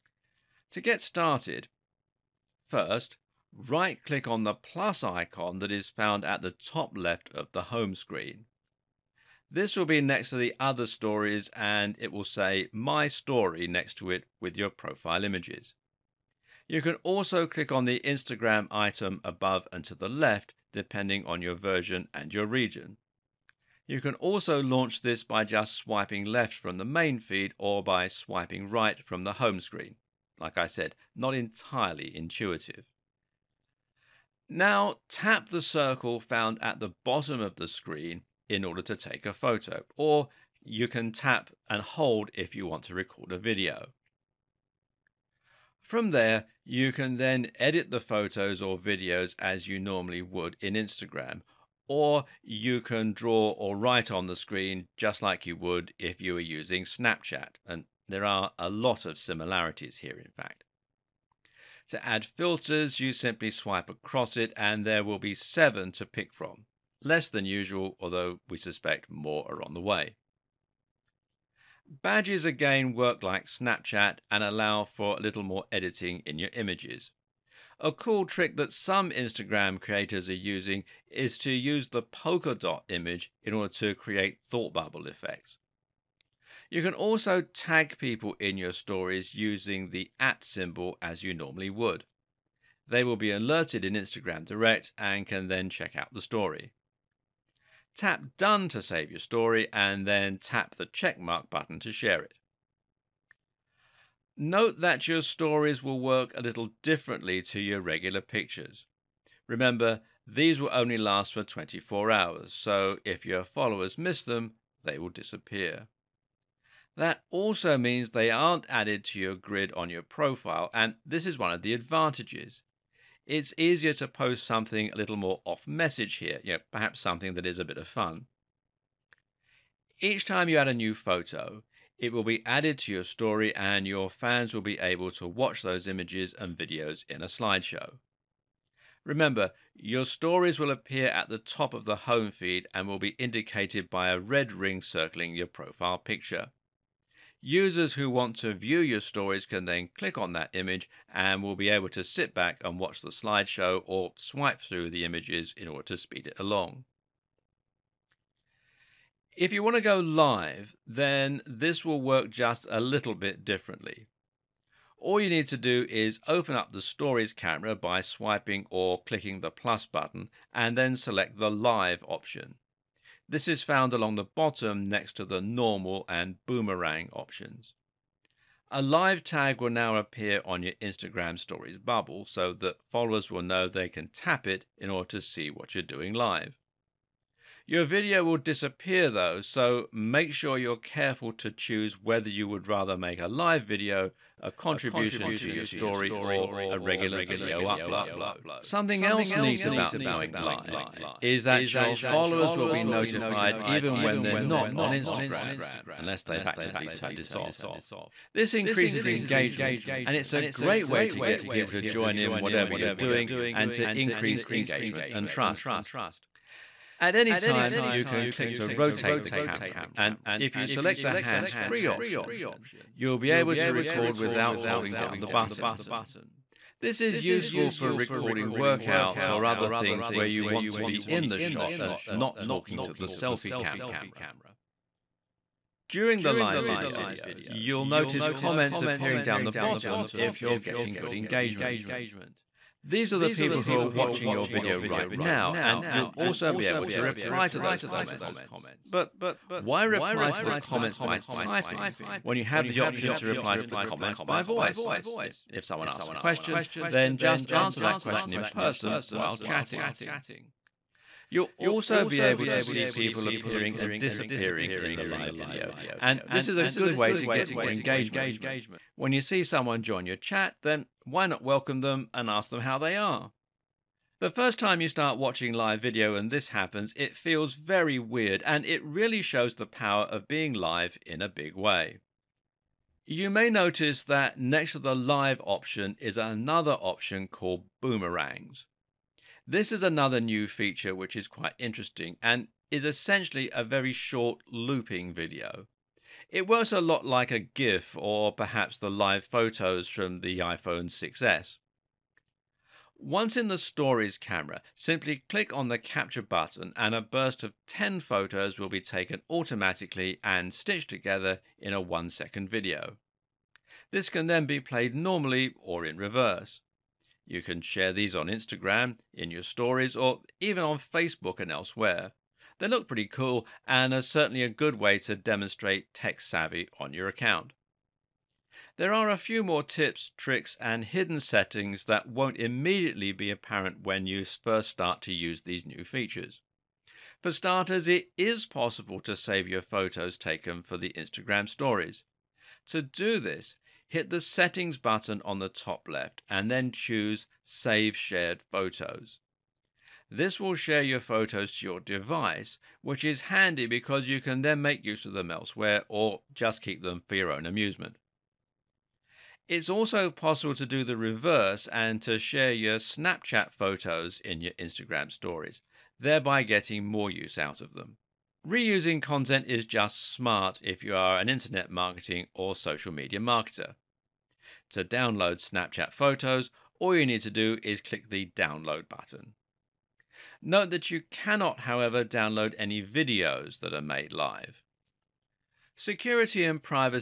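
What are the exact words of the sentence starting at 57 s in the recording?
And there are a lot of similarities here, in fact.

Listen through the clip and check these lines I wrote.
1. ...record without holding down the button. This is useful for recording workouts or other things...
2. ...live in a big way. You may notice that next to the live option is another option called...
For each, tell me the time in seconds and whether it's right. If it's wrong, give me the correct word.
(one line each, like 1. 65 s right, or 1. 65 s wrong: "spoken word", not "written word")
1. 223 s right
2. 280 s right.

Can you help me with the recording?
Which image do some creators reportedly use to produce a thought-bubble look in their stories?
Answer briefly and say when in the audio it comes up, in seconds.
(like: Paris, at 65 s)
polka dot image, at 82 s.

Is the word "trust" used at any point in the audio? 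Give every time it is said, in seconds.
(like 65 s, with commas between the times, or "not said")
215 s.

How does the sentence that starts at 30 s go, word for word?
Like I said, not entirely intuitive.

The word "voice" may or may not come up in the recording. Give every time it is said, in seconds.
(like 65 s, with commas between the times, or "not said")
254 s.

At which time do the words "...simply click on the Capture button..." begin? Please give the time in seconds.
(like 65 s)
304 s.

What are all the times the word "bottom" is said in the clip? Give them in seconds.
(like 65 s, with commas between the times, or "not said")
37 s, 174 s, 239 s.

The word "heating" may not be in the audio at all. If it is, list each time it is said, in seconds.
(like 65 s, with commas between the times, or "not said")
not said.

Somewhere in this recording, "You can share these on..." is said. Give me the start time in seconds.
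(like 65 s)
317 s.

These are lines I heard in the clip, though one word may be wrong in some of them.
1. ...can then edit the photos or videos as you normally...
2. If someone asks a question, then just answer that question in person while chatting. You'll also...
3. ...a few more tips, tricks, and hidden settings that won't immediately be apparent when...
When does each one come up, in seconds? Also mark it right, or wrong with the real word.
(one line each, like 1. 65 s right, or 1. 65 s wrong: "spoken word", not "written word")
1. 46 s right
2. 255 s right
3. 329 s right.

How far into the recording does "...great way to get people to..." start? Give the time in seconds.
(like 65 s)
210 s.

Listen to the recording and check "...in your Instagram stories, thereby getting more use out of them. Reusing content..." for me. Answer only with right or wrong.
right.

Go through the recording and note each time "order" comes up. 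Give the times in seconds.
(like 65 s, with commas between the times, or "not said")
38 s, 83 s, 155 s, 184 s.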